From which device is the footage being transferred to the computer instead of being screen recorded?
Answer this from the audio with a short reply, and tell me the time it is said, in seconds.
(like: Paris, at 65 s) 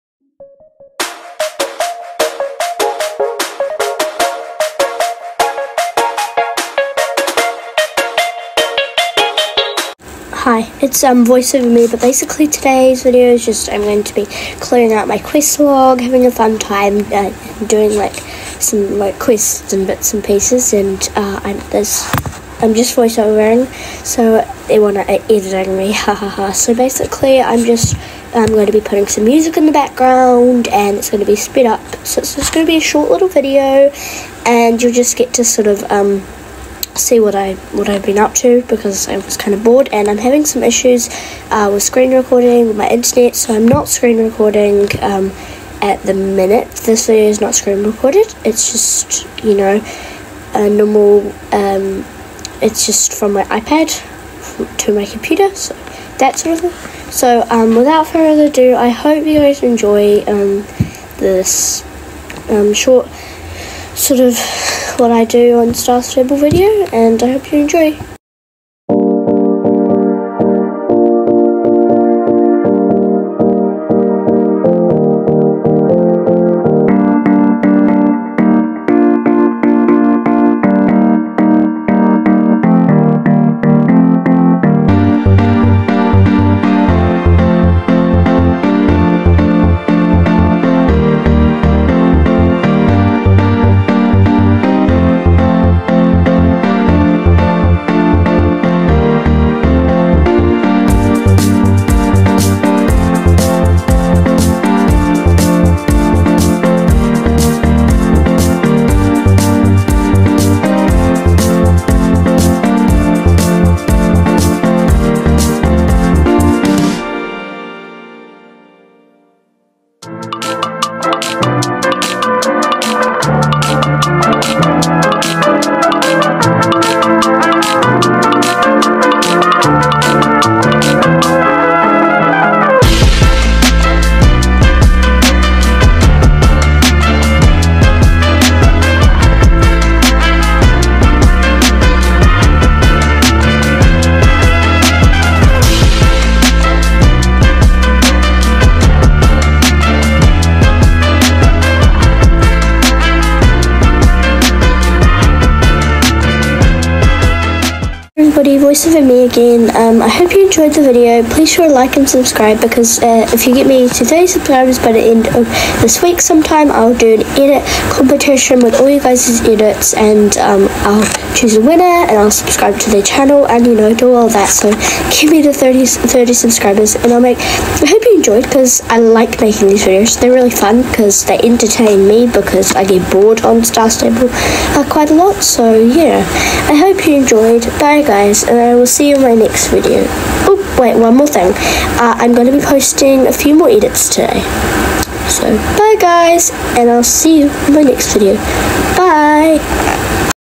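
iPad, at 53 s.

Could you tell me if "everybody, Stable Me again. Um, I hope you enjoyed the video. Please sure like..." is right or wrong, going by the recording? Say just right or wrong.
wrong.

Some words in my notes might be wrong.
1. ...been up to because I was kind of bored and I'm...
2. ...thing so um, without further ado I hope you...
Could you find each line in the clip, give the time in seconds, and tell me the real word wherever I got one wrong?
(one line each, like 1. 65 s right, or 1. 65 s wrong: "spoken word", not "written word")
1. 38 s right
2. 56 s right.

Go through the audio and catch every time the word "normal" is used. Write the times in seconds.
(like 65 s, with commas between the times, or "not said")
50 s.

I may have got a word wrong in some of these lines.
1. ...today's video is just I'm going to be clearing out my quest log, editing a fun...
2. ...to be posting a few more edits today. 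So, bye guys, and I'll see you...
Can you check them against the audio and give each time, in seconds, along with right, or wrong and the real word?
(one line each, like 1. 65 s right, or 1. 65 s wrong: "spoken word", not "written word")
1. 12 s wrong: "having", not "editing"
2. 192 s right.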